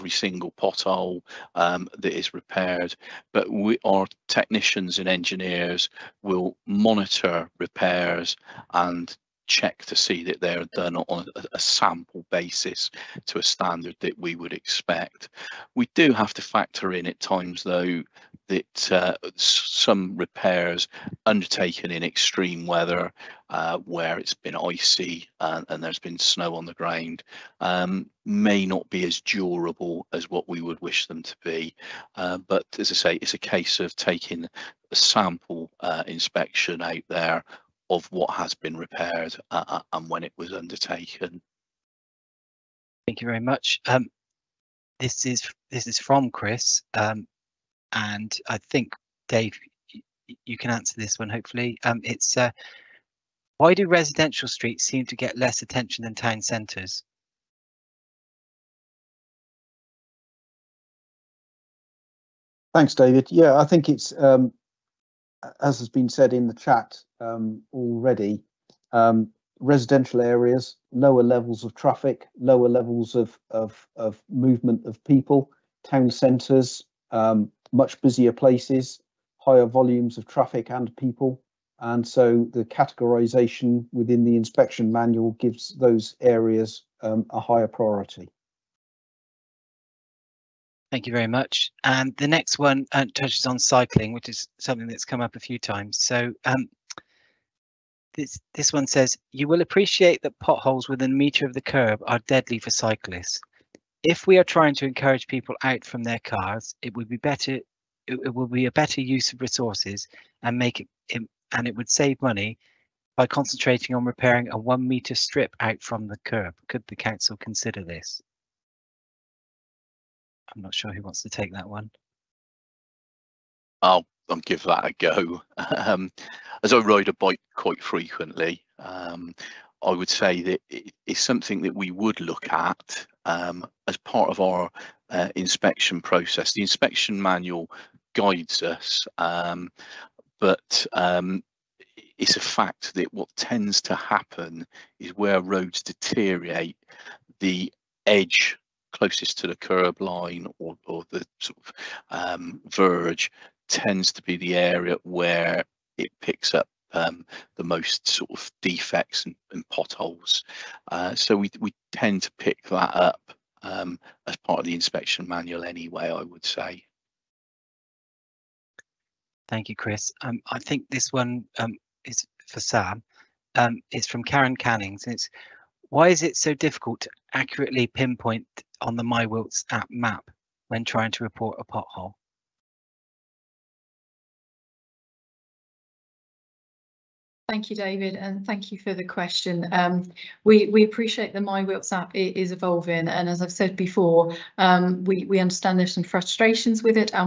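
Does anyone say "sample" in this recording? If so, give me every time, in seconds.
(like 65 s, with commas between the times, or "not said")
11 s, 34 s.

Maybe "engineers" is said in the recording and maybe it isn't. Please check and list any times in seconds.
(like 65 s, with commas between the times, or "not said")
5 s.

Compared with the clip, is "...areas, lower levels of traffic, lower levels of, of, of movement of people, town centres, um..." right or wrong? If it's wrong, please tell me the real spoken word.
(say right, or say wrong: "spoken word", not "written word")
right.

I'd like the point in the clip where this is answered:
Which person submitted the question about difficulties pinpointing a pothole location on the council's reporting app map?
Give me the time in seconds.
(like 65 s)
174 s.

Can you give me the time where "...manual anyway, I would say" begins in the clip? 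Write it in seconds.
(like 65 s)
165 s.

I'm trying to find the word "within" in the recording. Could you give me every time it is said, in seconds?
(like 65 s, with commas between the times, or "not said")
83 s, 100 s.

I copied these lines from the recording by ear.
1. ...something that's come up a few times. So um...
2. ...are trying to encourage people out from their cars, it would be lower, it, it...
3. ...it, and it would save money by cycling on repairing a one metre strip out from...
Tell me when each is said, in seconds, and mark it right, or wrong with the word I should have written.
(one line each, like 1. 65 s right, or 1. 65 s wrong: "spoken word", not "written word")
1. 94 s right
2. 104 s wrong: "better", not "lower"
3. 111 s wrong: "concentrating", not "cycling".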